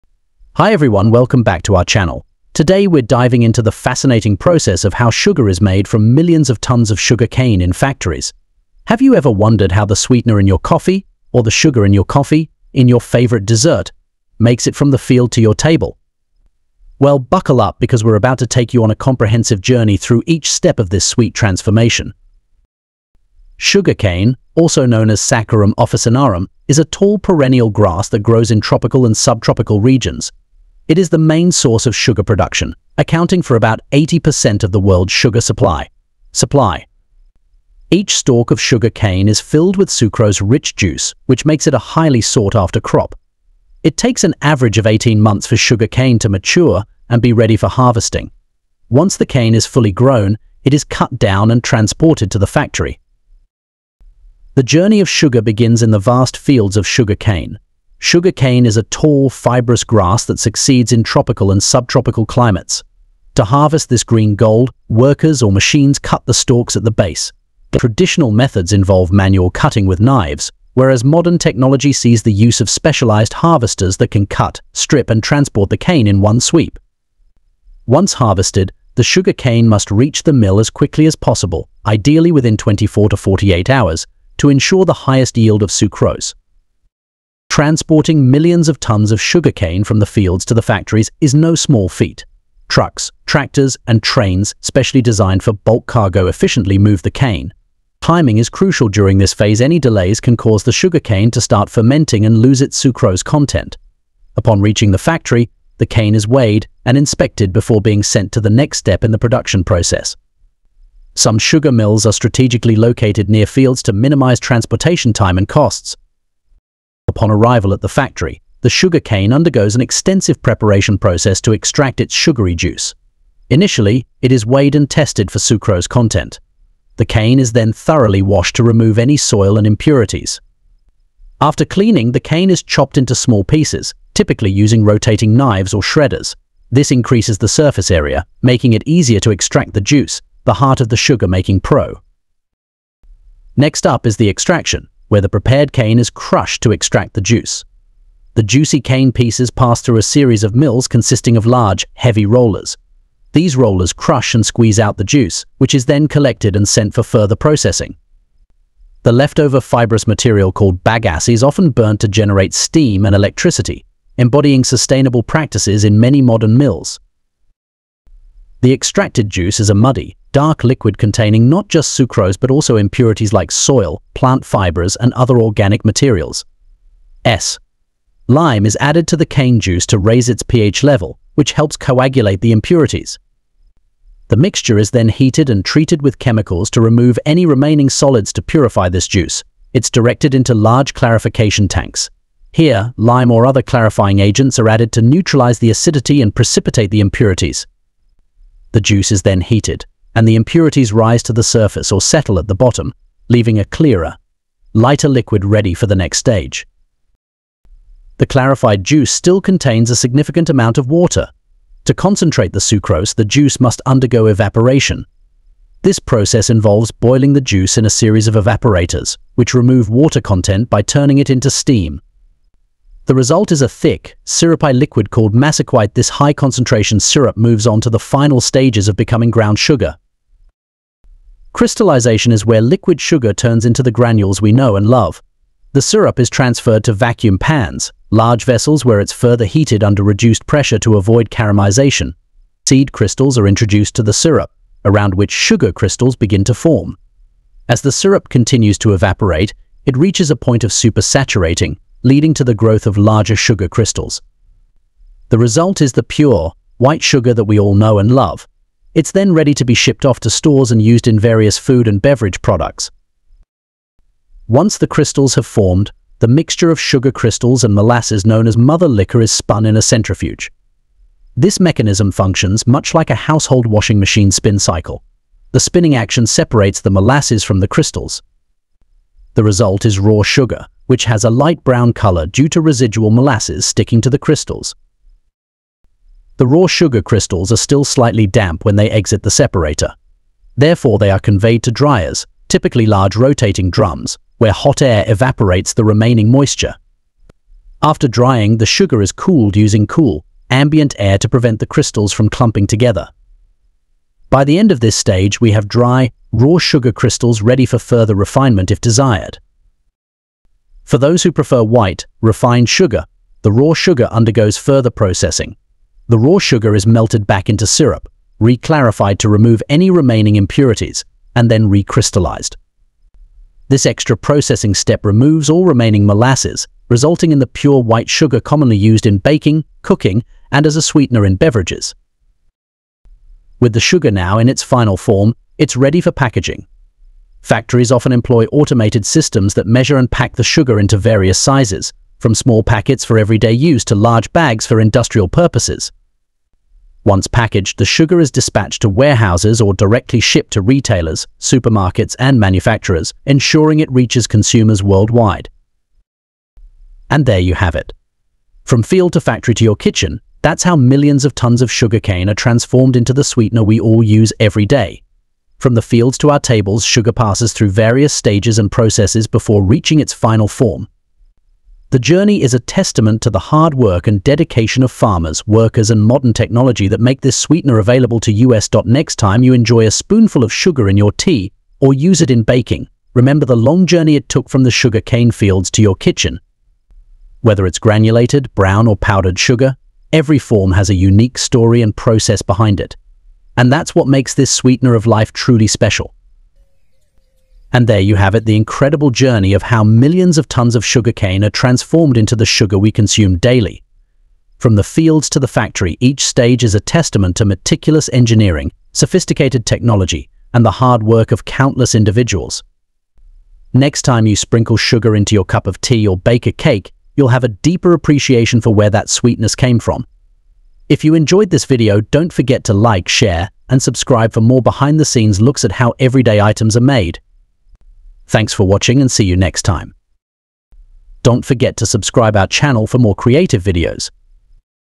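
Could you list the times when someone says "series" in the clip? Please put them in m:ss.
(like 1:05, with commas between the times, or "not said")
2:30, 3:37.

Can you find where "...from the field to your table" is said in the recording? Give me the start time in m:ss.
0:14.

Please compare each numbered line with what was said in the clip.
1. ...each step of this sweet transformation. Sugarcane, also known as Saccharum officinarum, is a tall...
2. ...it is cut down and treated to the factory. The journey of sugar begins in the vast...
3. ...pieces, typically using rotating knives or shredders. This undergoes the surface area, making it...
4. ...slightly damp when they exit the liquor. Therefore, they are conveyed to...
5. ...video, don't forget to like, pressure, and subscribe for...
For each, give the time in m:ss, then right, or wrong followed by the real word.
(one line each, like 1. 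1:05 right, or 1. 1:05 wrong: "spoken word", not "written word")
1. 0:20 right
2. 0:50 wrong: "transported", not "treated"
3. 2:13 wrong: "increases", not "undergoes"
4. 4:47 wrong: "separator", not "liquor"
5. 7:01 wrong: "share", not "pressure".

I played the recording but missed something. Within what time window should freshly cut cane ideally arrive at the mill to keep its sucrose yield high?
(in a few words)
24 to 48 hours.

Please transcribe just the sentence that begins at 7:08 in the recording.
Thanks for watching and see you next time.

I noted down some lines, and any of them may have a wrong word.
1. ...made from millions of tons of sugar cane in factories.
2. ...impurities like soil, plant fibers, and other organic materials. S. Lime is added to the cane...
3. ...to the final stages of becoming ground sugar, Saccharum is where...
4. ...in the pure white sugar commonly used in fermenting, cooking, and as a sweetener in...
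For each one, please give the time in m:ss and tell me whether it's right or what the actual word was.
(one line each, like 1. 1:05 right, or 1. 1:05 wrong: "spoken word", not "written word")
1. 0:05 right
2. 2:52 right
3. 3:47 wrong: "Crystallization", not "Saccharum"
4. 5:27 wrong: "baking", not "fermenting".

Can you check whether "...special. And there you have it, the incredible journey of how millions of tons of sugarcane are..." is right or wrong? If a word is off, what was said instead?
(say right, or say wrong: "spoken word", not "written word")
right.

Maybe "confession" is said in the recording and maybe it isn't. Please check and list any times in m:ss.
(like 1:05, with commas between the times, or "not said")
not said.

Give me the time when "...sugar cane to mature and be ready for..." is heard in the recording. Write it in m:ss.
0:45.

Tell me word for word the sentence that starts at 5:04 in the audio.
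By the end of this stage, we have dry, raw sugar crystals ready for further refinement if desired.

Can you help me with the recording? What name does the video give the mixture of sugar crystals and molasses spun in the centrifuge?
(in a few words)
mother liquor.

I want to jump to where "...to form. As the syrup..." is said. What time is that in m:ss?
4:06.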